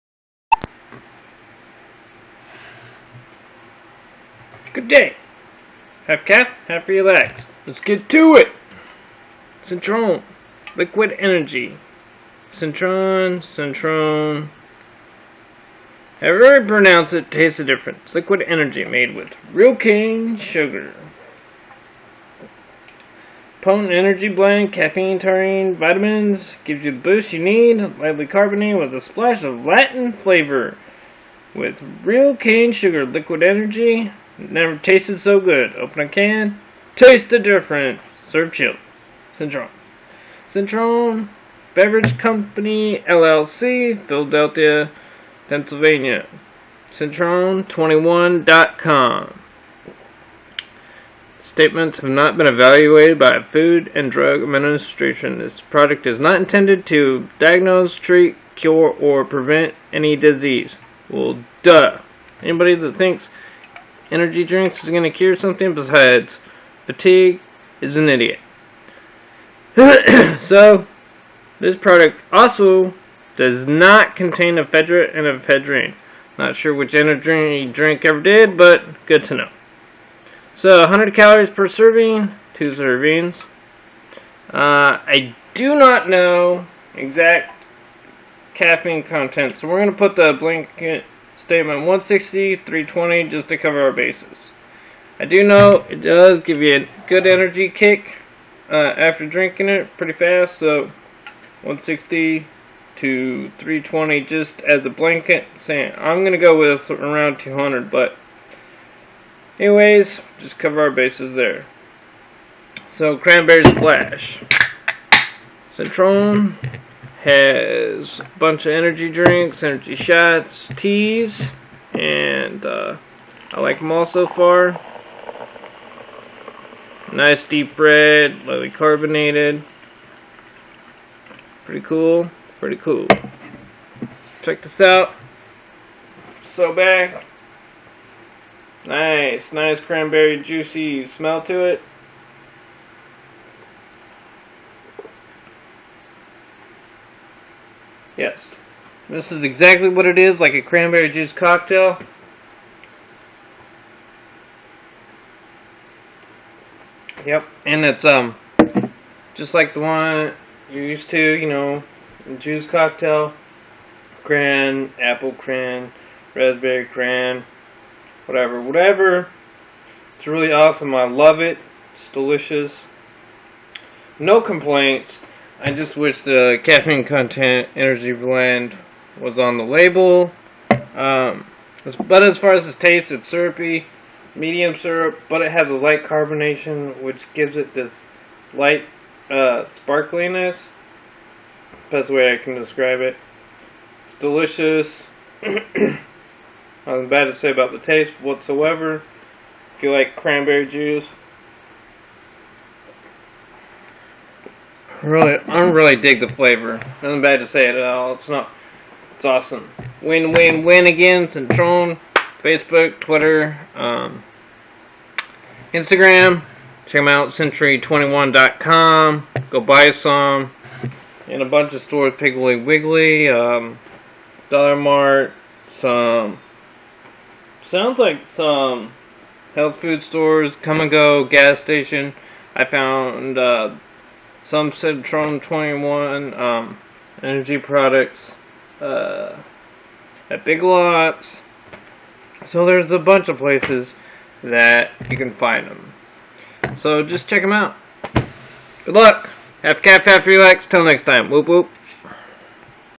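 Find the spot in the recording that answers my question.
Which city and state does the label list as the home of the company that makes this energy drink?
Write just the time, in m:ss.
0:44.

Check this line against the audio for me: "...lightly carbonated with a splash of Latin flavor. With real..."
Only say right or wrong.
right.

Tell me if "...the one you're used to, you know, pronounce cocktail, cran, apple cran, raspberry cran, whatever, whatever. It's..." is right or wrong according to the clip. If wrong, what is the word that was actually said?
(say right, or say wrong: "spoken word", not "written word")
wrong: "juice", not "pronounce".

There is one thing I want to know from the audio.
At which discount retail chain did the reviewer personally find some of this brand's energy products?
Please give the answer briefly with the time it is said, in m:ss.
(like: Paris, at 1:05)
Big Lots, at 4:00.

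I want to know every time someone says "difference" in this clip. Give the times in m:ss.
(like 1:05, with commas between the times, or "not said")
0:17, 0:37.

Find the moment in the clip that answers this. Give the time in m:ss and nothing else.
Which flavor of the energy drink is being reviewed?
1:53.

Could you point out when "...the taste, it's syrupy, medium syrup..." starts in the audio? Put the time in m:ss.
3:02.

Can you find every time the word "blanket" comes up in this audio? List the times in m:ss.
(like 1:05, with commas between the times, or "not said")
1:30, 1:44.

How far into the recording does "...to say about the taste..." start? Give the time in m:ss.
3:17.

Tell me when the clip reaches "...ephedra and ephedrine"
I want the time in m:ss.
1:14.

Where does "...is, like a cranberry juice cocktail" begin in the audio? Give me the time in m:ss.
2:30.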